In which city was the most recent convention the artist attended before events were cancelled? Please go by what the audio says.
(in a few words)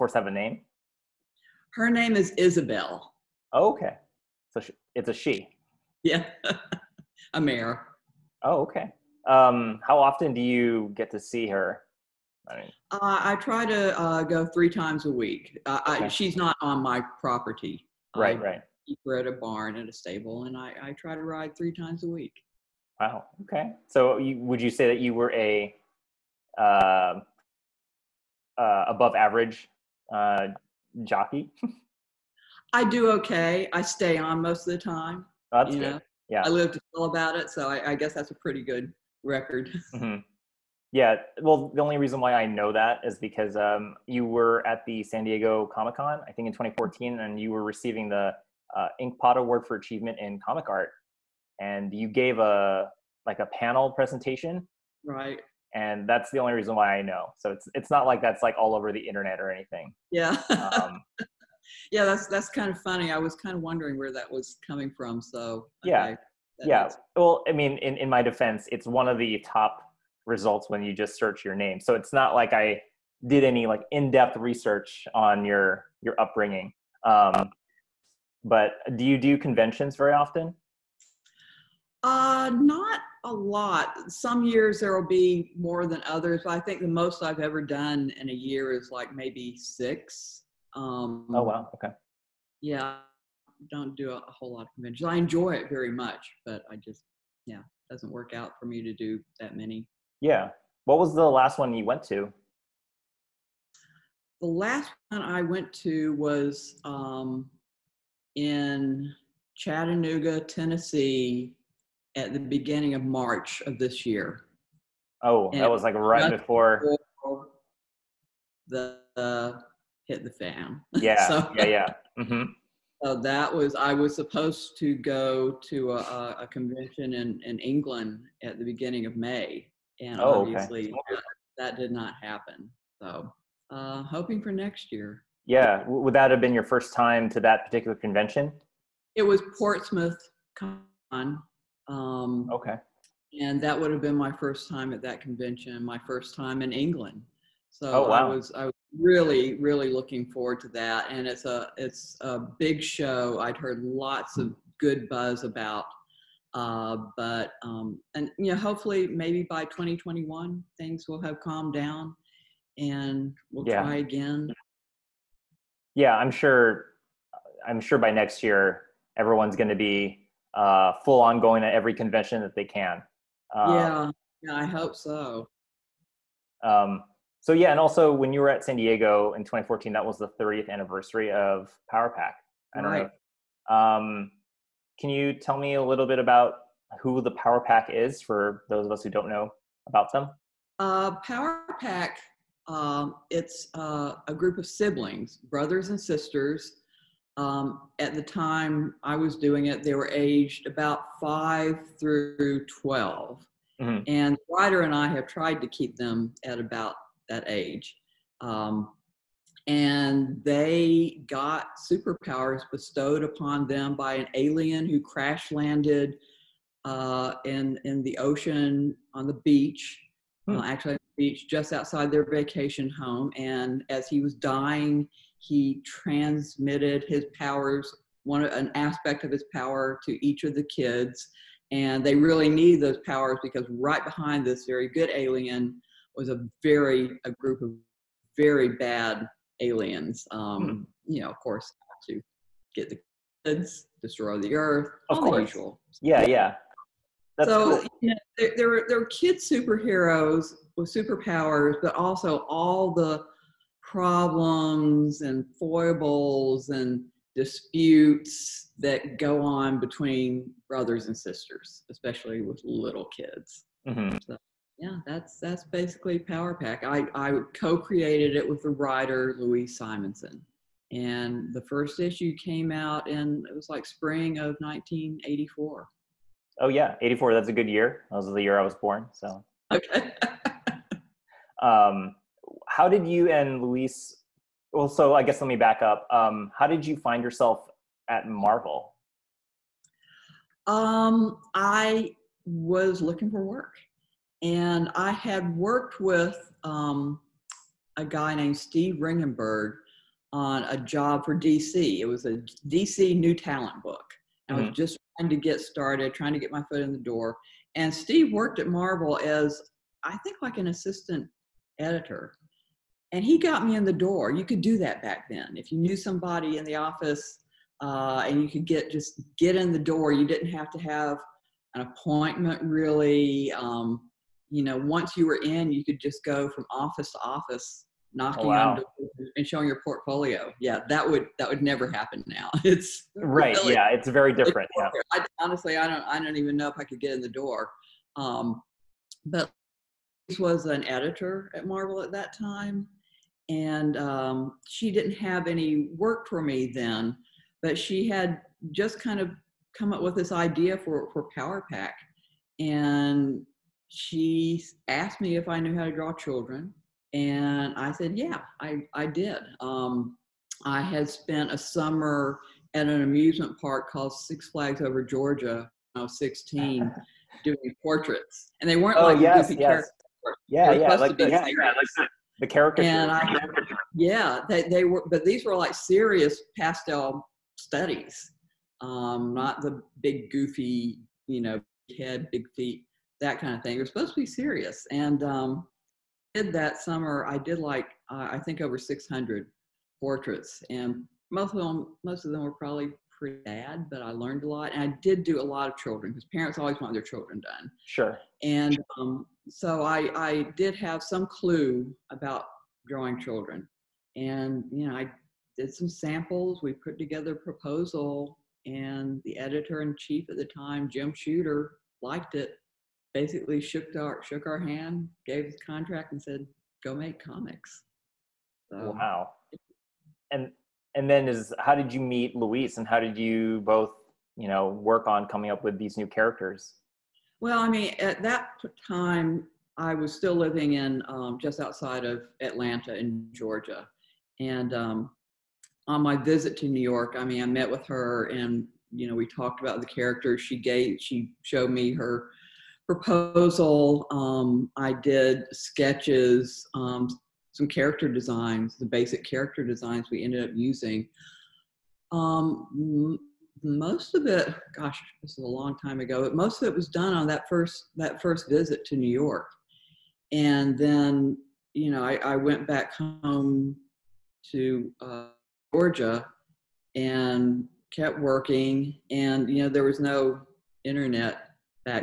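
Chattanooga, Tennessee.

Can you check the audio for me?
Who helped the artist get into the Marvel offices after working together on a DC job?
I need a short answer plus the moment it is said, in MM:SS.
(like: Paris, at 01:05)
Steve Ringgenberg, at 04:58.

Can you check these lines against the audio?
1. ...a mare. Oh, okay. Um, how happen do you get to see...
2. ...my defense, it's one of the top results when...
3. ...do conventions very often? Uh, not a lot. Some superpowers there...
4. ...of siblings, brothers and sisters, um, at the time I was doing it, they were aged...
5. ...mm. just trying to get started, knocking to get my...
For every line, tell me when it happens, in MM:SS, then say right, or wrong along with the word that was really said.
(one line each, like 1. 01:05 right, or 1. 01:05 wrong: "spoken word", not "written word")
1. 00:07 wrong: "often", not "happen"
2. 01:08 right
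3. 01:19 wrong: "years", not "superpowers"
4. 03:14 right
5. 05:04 wrong: "trying", not "knocking".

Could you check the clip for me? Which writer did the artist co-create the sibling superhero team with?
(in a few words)
Louise Simonson.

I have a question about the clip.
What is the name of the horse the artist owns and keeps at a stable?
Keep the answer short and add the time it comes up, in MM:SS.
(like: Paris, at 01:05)
Isabel, at 00:02.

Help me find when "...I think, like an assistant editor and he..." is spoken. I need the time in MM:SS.
05:10.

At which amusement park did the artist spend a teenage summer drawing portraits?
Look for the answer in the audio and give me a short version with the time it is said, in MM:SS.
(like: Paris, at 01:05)
Six Flags Over Georgia, at 06:04.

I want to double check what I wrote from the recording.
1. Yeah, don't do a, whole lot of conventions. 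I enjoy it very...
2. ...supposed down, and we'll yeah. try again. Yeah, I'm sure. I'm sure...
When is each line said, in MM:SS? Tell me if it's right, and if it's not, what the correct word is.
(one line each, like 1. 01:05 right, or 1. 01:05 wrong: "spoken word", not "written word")
1. 01:32 right
2. 02:41 wrong: "calmed", not "supposed".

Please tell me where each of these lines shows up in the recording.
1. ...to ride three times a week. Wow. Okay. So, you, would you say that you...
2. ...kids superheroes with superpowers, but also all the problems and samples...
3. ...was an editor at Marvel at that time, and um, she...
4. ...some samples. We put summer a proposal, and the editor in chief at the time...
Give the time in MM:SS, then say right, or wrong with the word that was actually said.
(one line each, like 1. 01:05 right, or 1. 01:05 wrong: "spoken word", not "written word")
1. 00:21 right
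2. 04:09 wrong: "foibles", not "samples"
3. 05:40 right
4. 06:45 wrong: "together", not "summer".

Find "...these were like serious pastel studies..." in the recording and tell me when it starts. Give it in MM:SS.
06:15.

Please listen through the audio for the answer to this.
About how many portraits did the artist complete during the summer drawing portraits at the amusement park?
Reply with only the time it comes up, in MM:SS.
06:28.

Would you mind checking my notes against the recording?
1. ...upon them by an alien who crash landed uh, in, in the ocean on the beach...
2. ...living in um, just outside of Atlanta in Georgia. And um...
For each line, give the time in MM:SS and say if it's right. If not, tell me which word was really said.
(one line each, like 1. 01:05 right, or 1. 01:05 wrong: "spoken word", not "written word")
1. 03:33 right
2. 07:10 right.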